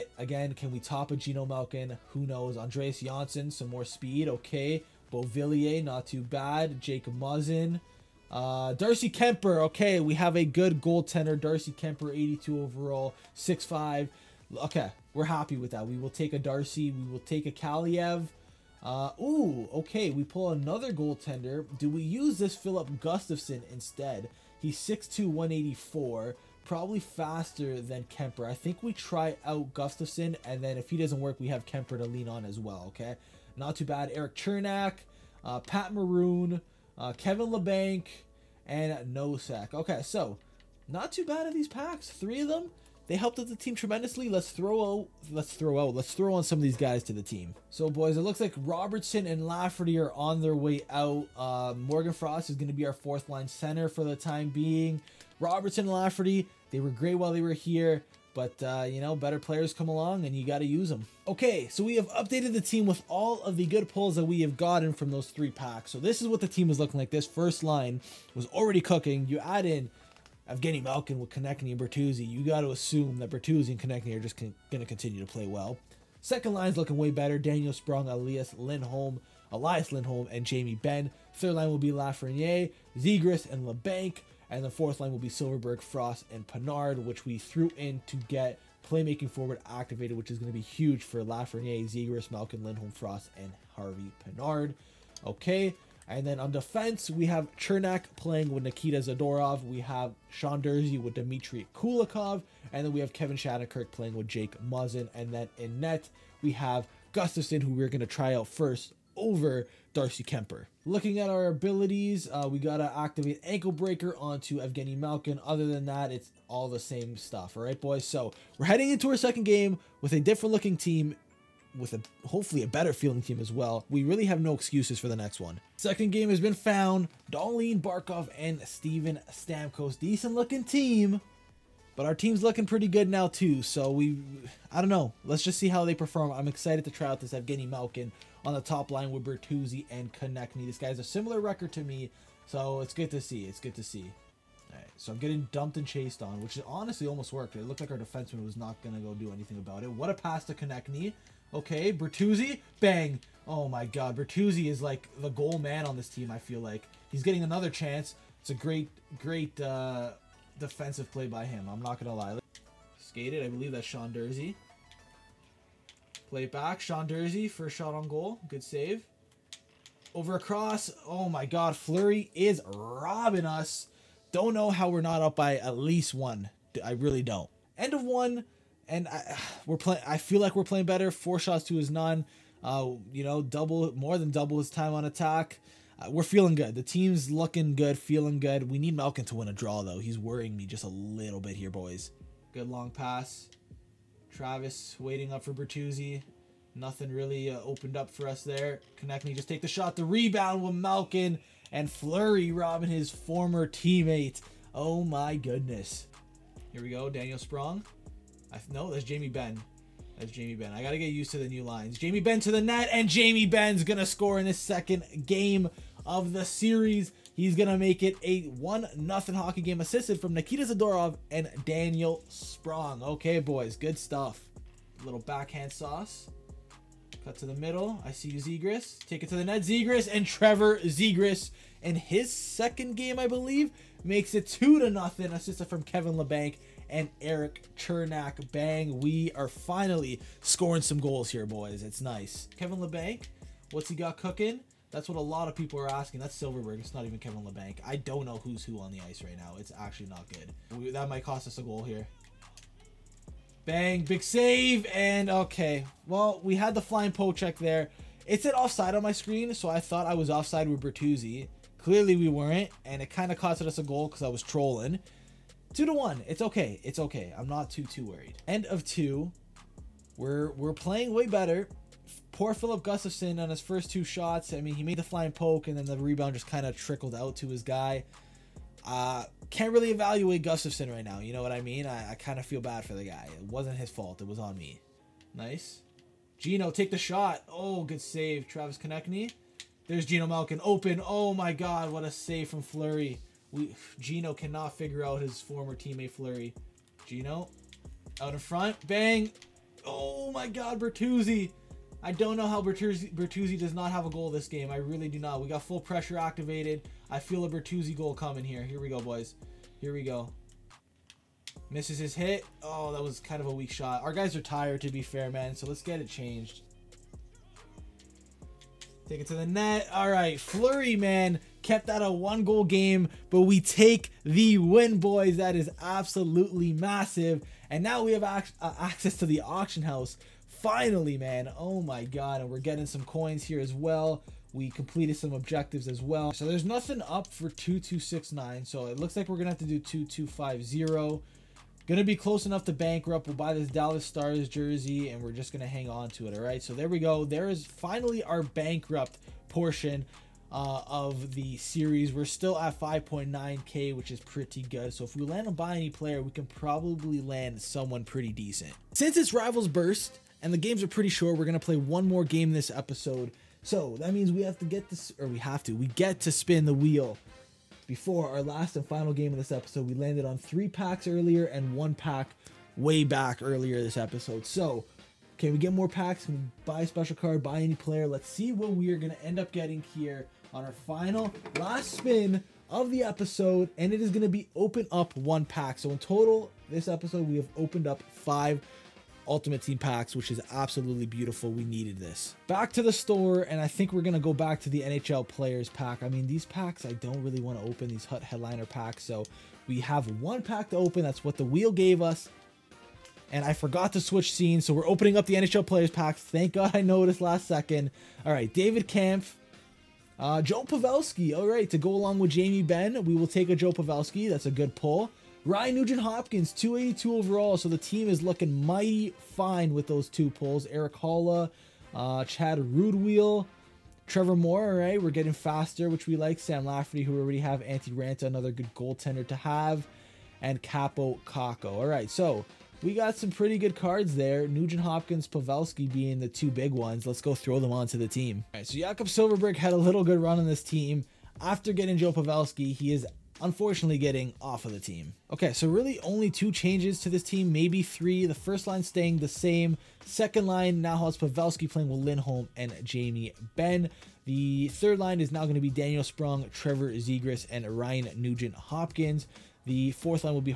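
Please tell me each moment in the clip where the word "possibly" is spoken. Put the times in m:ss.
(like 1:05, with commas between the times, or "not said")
not said.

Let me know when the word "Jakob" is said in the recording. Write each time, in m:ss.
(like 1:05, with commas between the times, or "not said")
7:18.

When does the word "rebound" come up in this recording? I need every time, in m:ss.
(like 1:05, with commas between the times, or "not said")
3:20, 4:35.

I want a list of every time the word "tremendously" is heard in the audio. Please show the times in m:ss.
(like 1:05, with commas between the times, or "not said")
0:43.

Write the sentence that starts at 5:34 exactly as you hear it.
We completed some objectives as well.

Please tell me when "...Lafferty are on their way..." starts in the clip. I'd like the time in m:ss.
0:49.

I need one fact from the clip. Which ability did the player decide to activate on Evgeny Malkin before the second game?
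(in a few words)
Ankle Breaker.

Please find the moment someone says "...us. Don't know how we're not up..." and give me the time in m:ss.
2:53.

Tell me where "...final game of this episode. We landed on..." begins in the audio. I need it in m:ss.
6:08.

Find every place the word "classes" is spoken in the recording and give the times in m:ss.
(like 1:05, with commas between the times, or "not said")
not said.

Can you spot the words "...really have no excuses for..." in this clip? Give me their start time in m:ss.
2:04.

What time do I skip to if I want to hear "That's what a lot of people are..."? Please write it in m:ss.
4:04.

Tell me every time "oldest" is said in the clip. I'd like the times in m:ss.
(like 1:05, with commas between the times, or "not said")
not said.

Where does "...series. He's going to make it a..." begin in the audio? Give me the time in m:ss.
3:36.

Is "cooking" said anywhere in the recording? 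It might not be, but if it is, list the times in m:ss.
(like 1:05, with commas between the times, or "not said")
1:08, 4:04.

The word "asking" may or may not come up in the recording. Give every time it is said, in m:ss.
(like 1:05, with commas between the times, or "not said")
4:05.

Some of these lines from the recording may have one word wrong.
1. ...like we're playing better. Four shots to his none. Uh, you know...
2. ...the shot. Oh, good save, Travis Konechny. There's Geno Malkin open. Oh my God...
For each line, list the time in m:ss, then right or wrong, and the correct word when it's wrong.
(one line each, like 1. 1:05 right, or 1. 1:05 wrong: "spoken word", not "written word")
1. 3:00 right
2. 4:46 right.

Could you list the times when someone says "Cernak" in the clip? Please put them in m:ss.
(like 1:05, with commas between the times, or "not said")
0:34, 1:37, 3:57.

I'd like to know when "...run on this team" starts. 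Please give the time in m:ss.
7:20.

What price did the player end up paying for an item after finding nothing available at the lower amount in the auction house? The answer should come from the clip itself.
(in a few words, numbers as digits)
2250.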